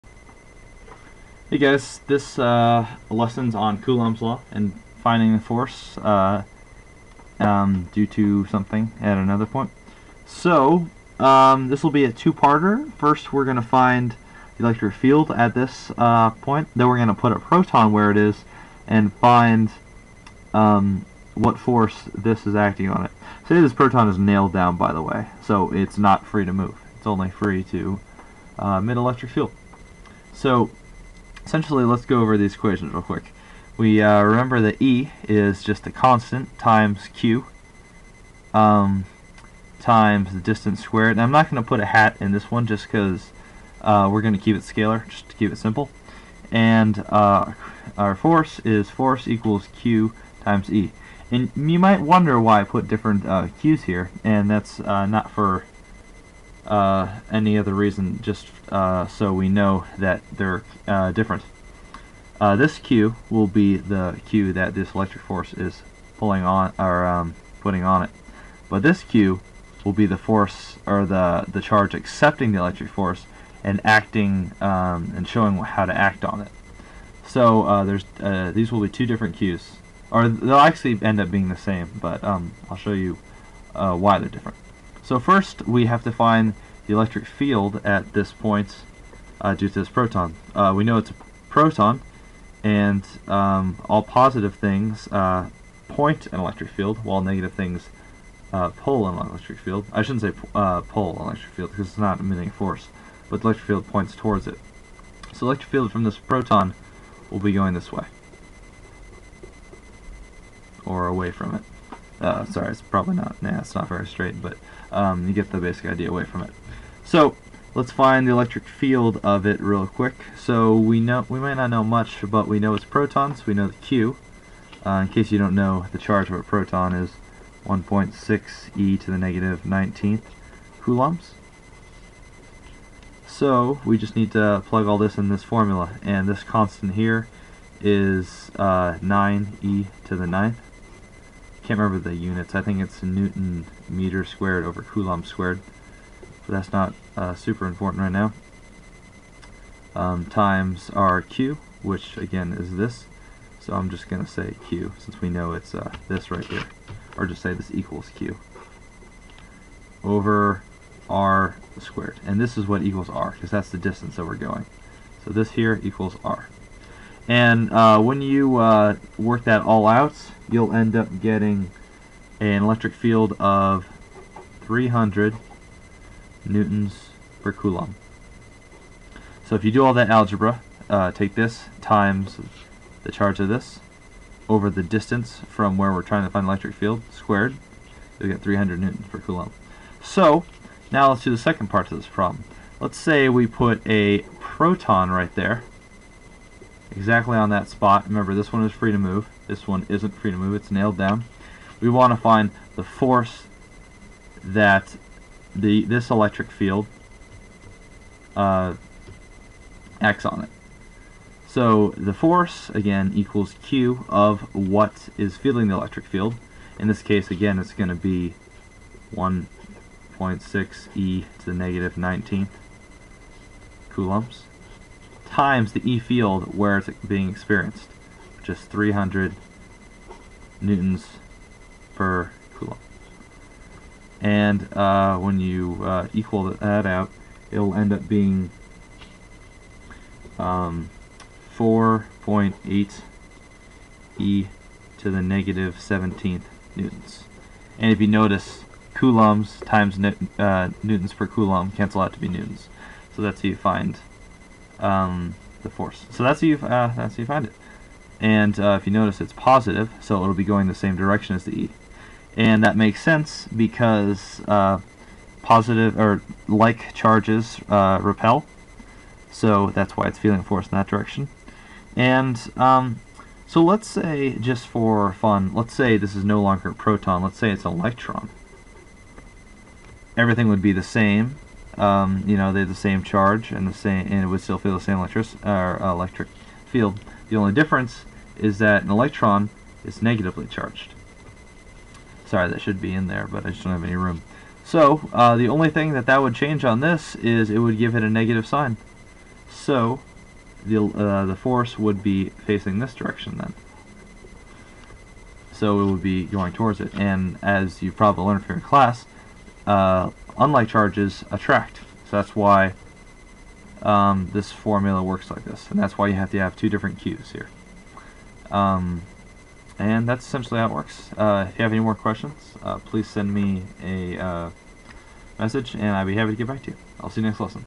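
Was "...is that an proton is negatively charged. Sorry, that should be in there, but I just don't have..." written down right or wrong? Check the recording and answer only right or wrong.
wrong.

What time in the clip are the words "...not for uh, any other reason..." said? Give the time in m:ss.
0:55.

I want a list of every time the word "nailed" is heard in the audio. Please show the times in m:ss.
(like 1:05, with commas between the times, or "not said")
0:24, 3:20.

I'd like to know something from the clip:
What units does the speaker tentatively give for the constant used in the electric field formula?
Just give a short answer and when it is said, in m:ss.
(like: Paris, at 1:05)
Newton meter squared over coulomb squared, at 2:23.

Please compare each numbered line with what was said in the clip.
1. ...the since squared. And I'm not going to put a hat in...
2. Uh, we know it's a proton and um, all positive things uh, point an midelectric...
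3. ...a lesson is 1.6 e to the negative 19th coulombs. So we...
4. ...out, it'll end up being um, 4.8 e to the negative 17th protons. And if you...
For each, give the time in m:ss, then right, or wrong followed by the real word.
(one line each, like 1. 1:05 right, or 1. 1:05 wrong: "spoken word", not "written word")
1. 0:40 wrong: "distance", not "since"
2. 1:30 wrong: "electric", not "midelectric"
3. 2:06 wrong: "proton", not "lesson"
4. 3:56 wrong: "newtons", not "protons".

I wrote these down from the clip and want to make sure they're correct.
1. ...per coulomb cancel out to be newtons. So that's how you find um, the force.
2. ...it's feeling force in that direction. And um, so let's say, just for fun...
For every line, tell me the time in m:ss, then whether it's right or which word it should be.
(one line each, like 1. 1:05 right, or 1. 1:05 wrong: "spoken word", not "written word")
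1. 4:11 right
2. 4:30 right.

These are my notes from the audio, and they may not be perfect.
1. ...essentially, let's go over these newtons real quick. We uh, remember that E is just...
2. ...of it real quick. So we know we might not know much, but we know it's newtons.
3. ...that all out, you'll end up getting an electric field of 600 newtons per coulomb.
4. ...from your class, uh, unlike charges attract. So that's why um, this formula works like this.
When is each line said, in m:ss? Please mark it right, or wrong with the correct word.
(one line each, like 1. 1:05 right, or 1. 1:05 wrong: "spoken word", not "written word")
1. 0:31 wrong: "equations", not "newtons"
2. 1:59 wrong: "protons", not "newtons"
3. 2:49 wrong: "300", not "600"
4. 5:08 right.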